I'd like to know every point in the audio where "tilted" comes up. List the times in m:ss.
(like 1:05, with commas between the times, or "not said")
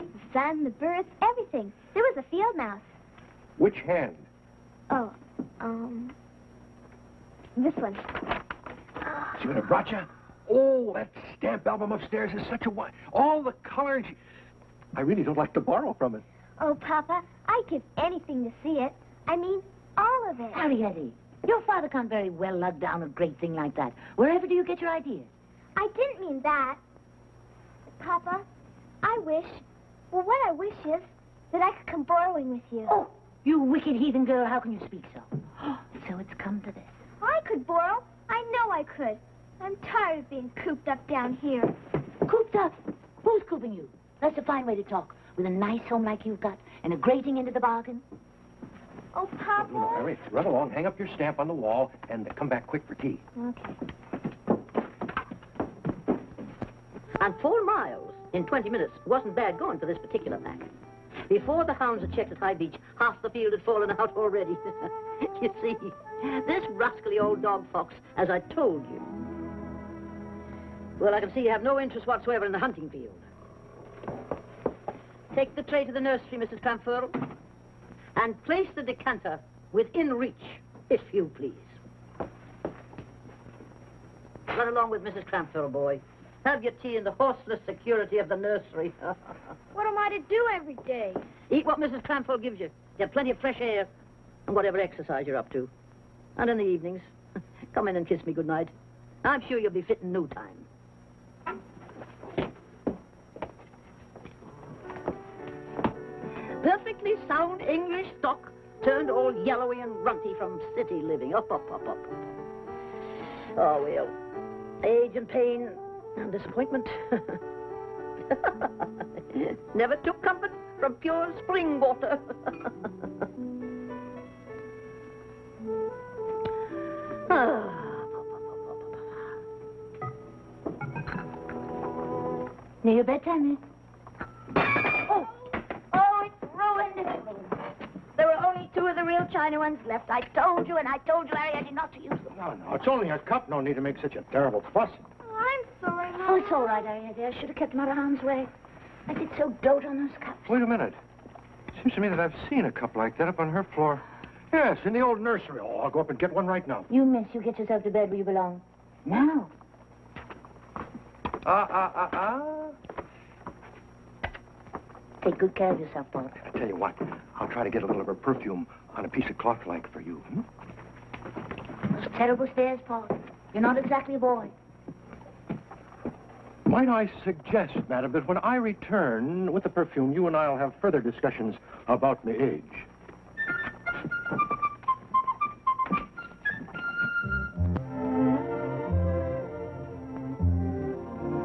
not said.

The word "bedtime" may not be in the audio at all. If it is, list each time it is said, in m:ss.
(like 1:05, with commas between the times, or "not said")
2:13.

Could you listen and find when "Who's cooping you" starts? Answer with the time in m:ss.
0:43.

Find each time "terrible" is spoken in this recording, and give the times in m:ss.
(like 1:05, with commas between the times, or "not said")
2:24, 2:52.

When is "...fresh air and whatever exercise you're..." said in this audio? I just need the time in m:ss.
1:33.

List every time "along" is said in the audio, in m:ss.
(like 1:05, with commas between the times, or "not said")
0:50, 1:24.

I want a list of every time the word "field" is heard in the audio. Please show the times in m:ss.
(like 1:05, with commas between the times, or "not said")
0:02, 1:03, 1:12.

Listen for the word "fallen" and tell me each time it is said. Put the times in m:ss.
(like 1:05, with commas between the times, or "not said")
1:03.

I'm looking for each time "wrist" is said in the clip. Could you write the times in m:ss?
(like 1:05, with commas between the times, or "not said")
not said.